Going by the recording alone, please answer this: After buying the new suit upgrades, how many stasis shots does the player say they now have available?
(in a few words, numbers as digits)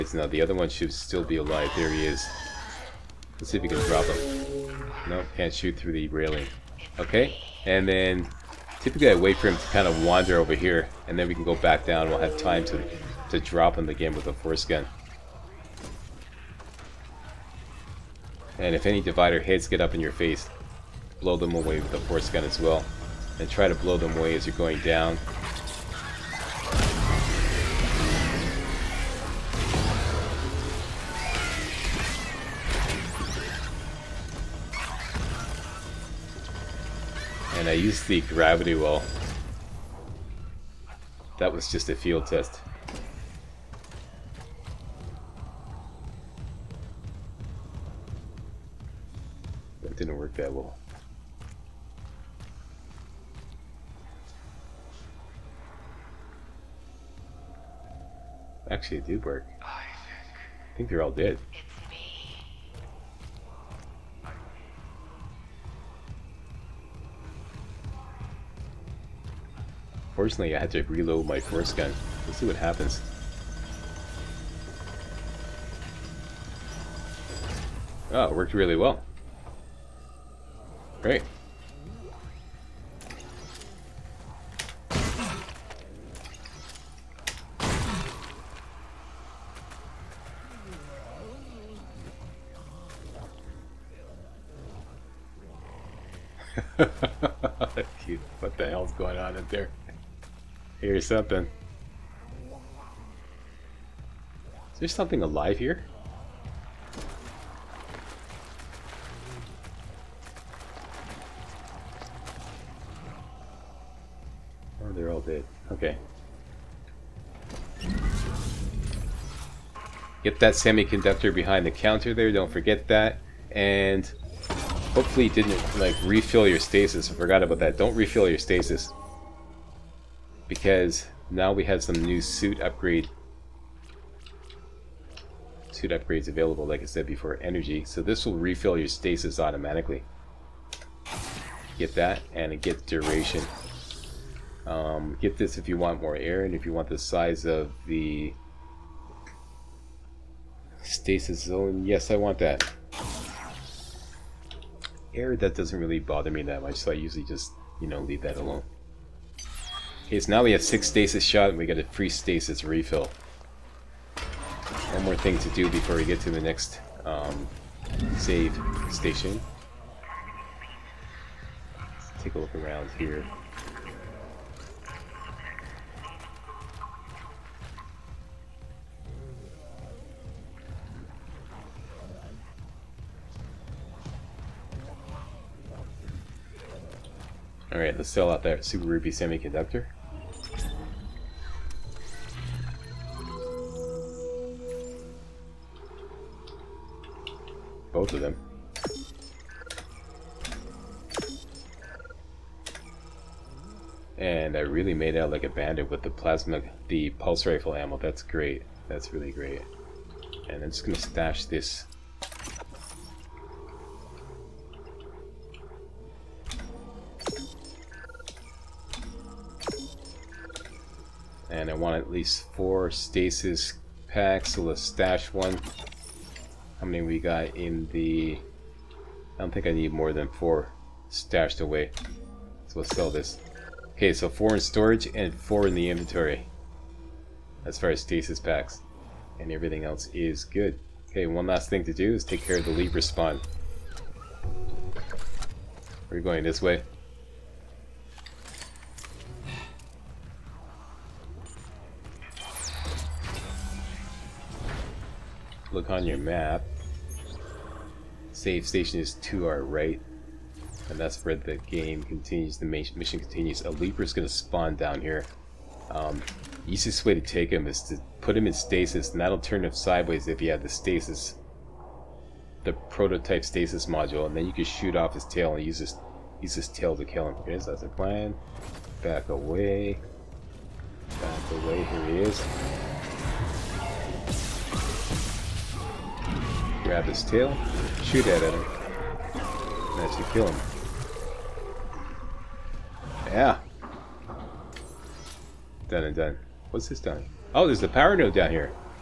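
6.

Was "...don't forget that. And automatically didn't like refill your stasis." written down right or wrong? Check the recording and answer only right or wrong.
wrong.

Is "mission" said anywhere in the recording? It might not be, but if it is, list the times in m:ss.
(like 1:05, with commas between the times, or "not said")
4:22.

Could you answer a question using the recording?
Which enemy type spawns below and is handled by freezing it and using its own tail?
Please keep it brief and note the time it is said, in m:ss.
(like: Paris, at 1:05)
Leaper, at 4:23.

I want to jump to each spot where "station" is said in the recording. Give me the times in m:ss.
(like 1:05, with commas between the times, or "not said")
2:48, 4:18.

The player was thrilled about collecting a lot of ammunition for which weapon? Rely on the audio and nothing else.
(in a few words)
Pulse rifle.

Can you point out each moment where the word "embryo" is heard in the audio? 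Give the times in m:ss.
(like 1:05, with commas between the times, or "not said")
not said.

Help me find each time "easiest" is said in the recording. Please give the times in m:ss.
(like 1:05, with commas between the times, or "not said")
4:26.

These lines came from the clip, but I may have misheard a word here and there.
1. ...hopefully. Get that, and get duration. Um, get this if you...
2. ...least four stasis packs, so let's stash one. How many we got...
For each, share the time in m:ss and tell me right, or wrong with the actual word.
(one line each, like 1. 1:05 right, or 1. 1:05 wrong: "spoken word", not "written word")
1. 2:19 wrong: "automatically", not "hopefully"
2. 3:42 right.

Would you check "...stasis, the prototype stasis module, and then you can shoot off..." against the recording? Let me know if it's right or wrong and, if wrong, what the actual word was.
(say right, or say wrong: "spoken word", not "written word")
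right.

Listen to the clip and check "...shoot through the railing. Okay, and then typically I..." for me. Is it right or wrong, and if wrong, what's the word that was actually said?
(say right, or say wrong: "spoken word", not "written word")
right.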